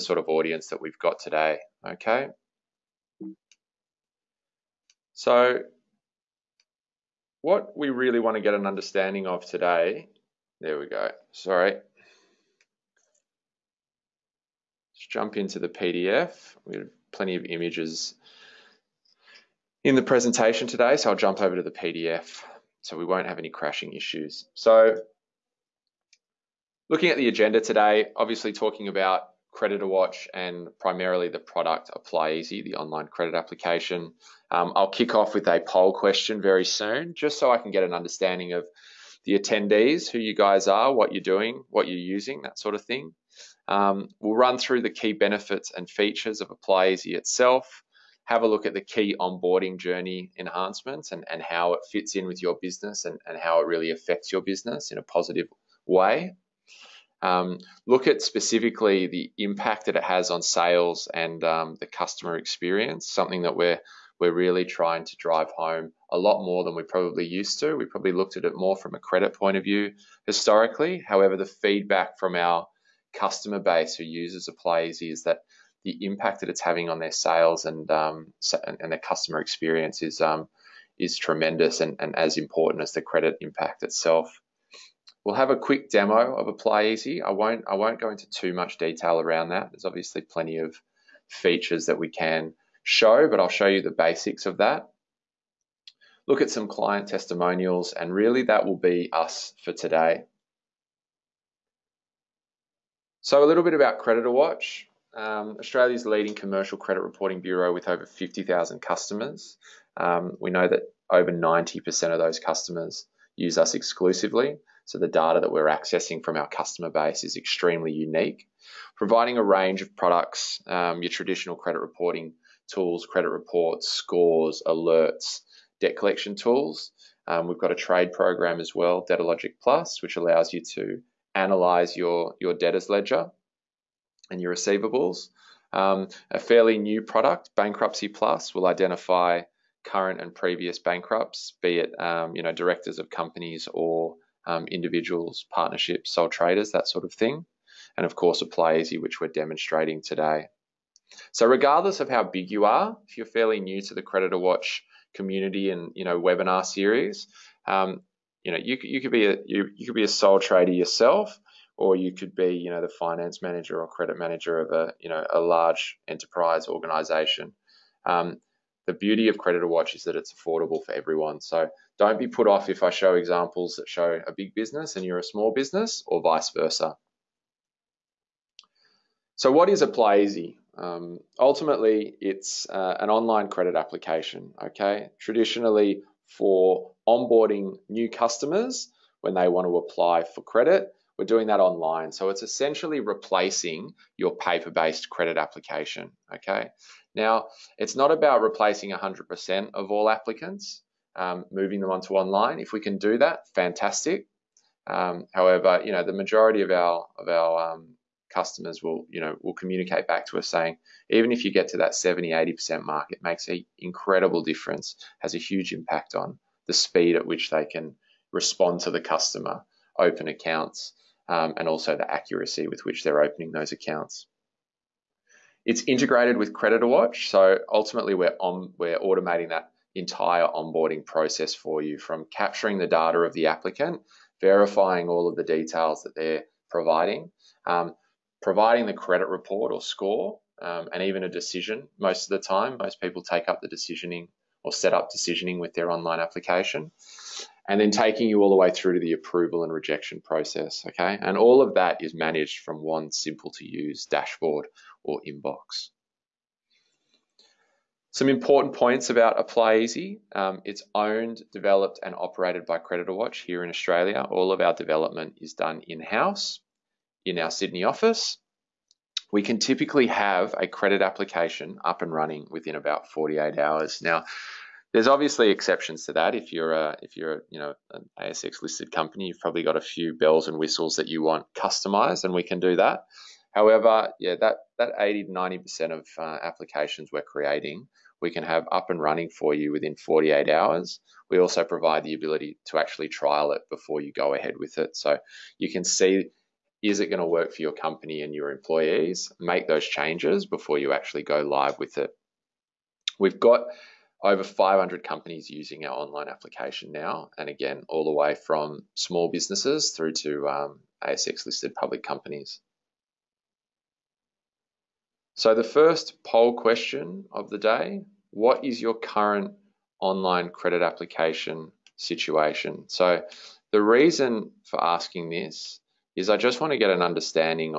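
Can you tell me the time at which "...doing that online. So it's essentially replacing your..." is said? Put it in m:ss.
3:11.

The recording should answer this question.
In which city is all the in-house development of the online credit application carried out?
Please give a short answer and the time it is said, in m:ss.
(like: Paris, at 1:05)
Sydney, at 4:27.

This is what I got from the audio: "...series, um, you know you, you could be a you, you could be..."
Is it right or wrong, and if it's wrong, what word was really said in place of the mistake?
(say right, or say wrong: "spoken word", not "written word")
right.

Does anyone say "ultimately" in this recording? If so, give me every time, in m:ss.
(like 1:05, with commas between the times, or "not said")
3:01, 3:47.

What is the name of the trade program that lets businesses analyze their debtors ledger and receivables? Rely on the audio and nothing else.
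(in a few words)
DataLogic Plus.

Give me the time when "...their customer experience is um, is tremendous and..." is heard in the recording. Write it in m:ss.
1:18.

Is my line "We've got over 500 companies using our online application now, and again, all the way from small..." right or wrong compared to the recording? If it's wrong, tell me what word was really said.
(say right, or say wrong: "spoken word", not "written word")
right.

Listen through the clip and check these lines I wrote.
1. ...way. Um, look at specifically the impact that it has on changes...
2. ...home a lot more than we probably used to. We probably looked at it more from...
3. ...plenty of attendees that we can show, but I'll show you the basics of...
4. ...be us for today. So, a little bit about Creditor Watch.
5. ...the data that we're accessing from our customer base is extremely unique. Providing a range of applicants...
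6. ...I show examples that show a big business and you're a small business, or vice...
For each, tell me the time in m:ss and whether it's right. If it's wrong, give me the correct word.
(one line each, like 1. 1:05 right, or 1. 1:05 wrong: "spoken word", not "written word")
1. 0:55 wrong: "sales", not "changes"
2. 1:05 right
3. 1:30 wrong: "features", not "attendees"
4. 1:38 right
5. 1:54 wrong: "products", not "applicants"
6. 2:52 right.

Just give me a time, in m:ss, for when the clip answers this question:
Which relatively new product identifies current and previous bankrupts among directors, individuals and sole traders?
2:17.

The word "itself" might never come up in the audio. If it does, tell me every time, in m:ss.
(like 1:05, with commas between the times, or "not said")
0:47, 1:23.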